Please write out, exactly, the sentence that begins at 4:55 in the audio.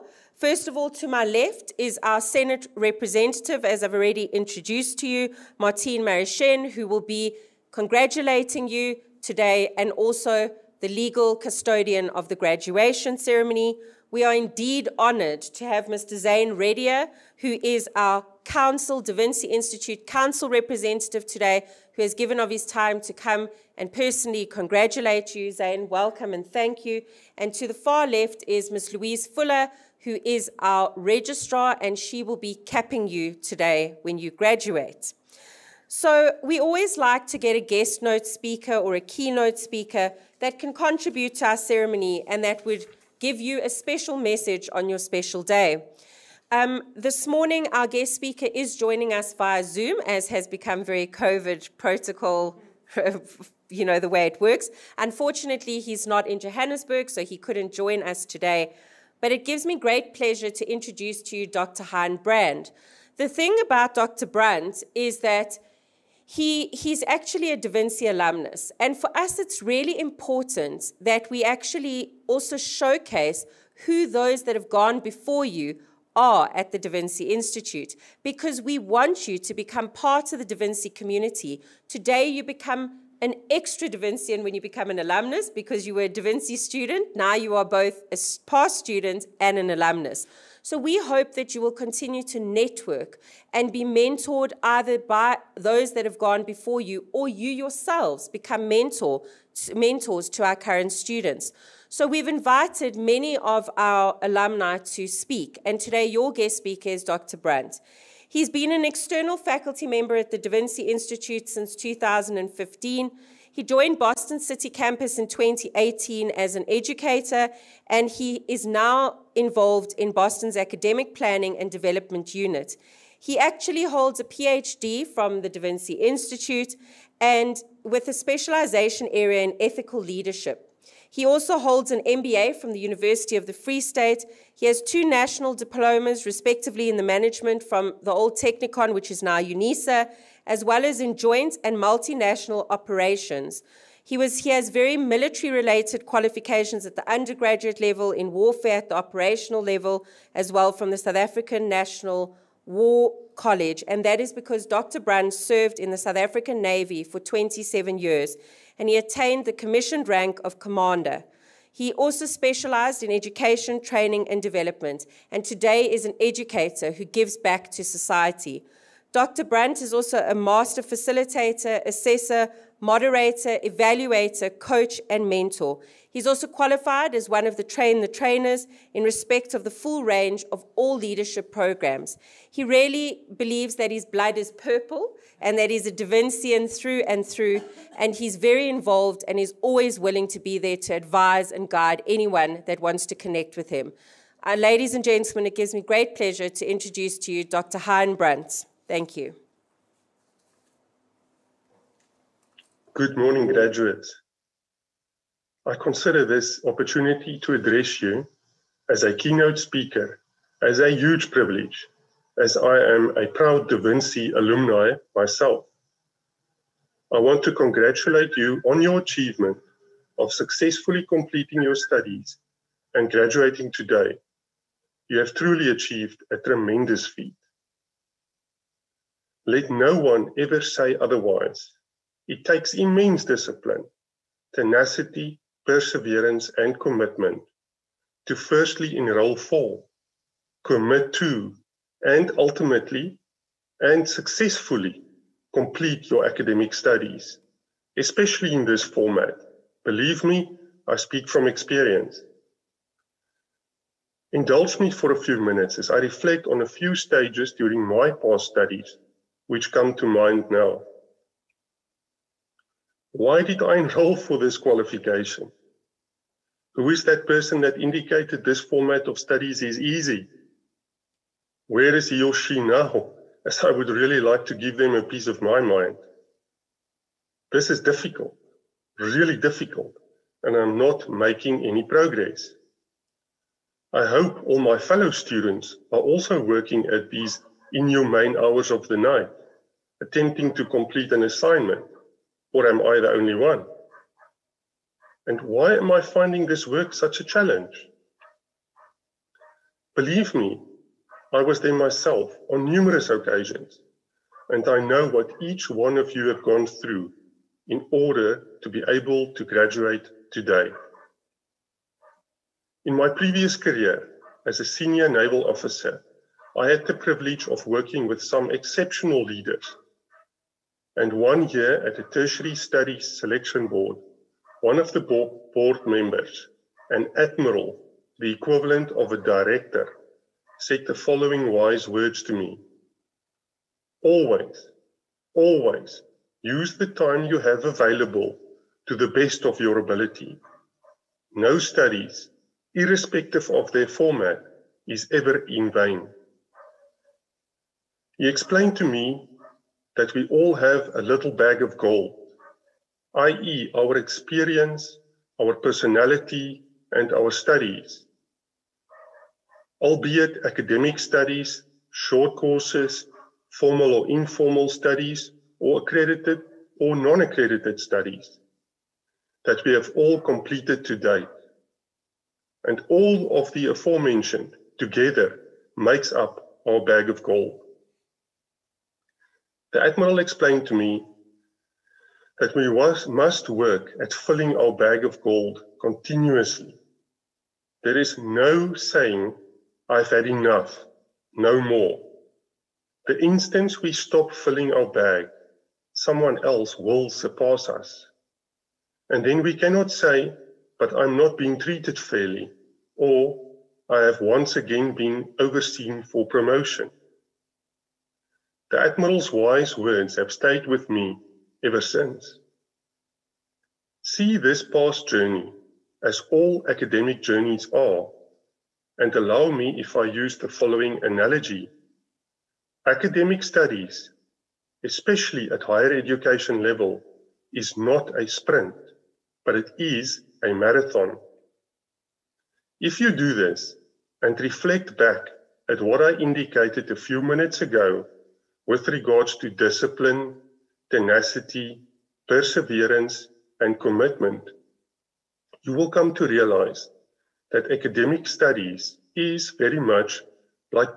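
And why am I finding this work such a challenge?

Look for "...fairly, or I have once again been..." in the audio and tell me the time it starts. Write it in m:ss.
6:41.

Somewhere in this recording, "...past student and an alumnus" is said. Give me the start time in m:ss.
1:28.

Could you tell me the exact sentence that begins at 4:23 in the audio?
Why did I enroll for this qualification?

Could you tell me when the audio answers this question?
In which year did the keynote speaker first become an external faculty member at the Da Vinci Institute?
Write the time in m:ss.
1:51.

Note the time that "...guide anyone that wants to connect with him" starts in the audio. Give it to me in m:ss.
3:11.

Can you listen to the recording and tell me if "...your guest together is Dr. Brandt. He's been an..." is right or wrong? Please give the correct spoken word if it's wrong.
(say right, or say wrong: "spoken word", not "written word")
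wrong: "speaker", not "together".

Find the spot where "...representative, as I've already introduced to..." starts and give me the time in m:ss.
0:02.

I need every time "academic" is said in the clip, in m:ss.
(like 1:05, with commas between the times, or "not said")
2:00, 4:06, 6:00, 6:56, 7:02, 7:27.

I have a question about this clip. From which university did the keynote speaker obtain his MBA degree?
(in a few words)
University of the Free State.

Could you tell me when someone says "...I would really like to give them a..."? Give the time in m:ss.
4:33.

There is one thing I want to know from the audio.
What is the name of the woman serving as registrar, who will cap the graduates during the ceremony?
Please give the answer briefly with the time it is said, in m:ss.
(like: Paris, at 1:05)
Louise Fuller, at 0:28.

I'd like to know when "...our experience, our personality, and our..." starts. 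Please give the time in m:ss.
5:53.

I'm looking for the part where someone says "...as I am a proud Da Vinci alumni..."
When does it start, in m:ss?
3:32.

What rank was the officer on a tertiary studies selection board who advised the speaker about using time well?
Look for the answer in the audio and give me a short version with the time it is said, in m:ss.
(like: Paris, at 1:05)
An admiral, at 5:26.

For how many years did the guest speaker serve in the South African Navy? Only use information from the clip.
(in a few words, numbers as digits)
27.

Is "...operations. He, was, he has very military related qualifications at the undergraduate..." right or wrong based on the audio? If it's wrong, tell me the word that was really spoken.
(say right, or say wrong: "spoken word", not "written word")
right.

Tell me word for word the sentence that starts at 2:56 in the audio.
He's also qualified as one of the train the trainers in respect of the full range of all leadership programs.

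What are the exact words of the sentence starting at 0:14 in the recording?
We are indeed honored to have Mr.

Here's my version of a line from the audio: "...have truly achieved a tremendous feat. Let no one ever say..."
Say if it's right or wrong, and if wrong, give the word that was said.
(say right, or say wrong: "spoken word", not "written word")
right.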